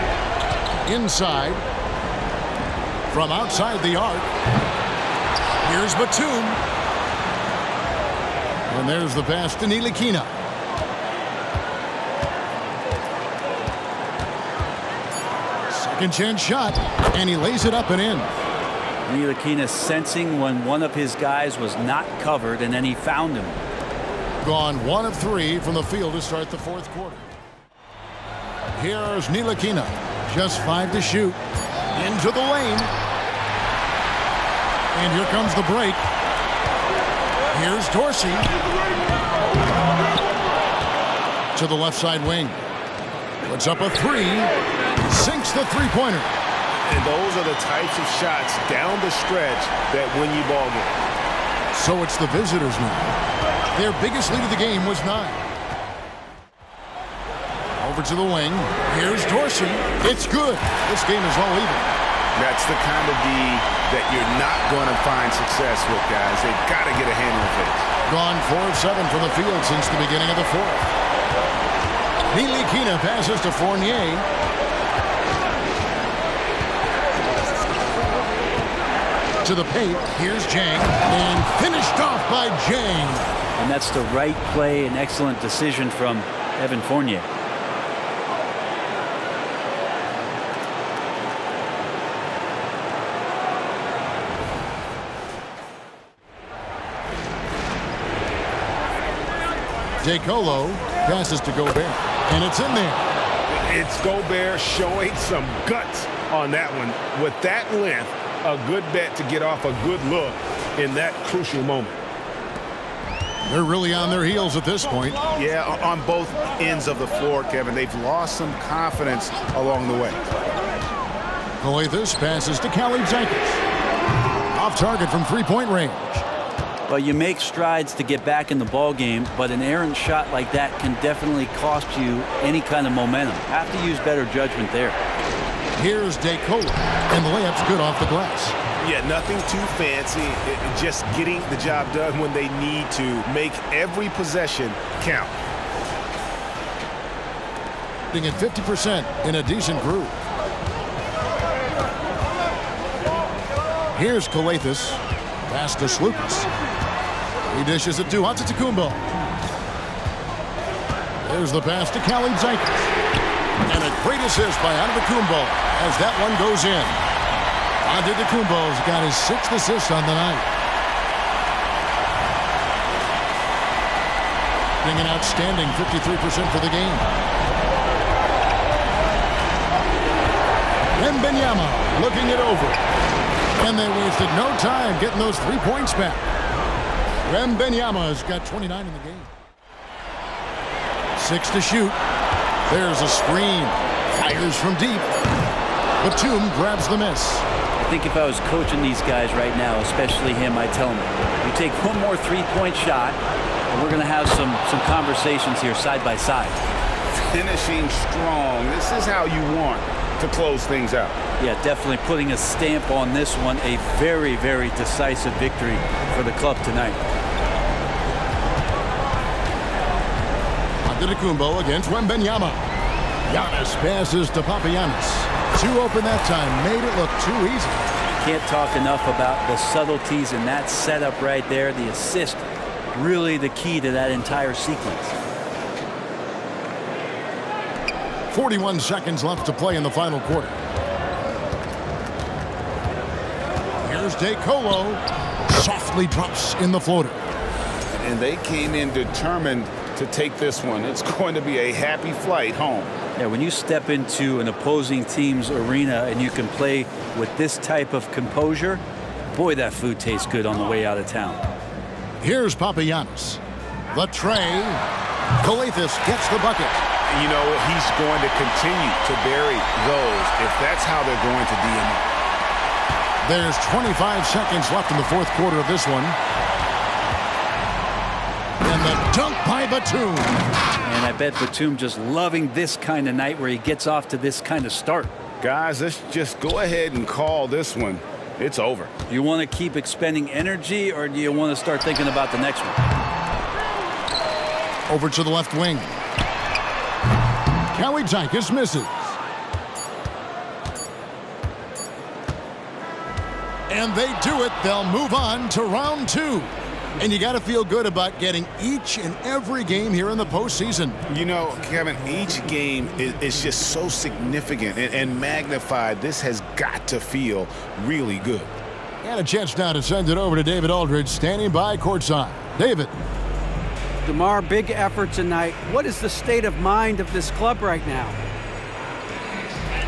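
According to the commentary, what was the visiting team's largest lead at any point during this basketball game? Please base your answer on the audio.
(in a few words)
9.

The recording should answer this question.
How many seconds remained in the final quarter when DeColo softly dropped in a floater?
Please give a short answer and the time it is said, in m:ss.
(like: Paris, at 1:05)
41, at 3:58.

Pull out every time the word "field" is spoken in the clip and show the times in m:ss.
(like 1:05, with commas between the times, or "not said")
0:25, 1:09.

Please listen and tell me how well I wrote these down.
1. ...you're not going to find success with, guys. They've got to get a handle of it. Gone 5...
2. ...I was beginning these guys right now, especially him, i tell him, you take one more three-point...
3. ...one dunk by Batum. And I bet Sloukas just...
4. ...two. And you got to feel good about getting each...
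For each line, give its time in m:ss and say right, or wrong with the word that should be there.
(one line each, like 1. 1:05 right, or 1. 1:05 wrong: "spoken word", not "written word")
1. 1:04 wrong: "4", not "5"
2. 3:18 wrong: "coaching", not "beginning"
3. 4:35 wrong: "Batum", not "Sloukas"
4. 5:06 right.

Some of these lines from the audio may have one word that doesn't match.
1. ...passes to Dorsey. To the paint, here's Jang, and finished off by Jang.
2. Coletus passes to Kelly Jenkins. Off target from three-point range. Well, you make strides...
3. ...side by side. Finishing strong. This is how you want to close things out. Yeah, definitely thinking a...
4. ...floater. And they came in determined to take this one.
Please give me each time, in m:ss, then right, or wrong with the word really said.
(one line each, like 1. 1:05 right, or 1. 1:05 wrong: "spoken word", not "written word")
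1. 1:13 wrong: "Fournier", not "Dorsey"
2. 2:01 right
3. 3:25 wrong: "putting", not "thinking"
4. 4:06 right.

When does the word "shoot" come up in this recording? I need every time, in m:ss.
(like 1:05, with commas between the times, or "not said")
0:31, 3:11.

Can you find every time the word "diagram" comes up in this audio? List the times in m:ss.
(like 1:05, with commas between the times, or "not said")
not said.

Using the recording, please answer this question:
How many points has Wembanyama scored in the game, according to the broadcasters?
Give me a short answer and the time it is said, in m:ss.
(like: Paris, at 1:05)
29, at 3:07.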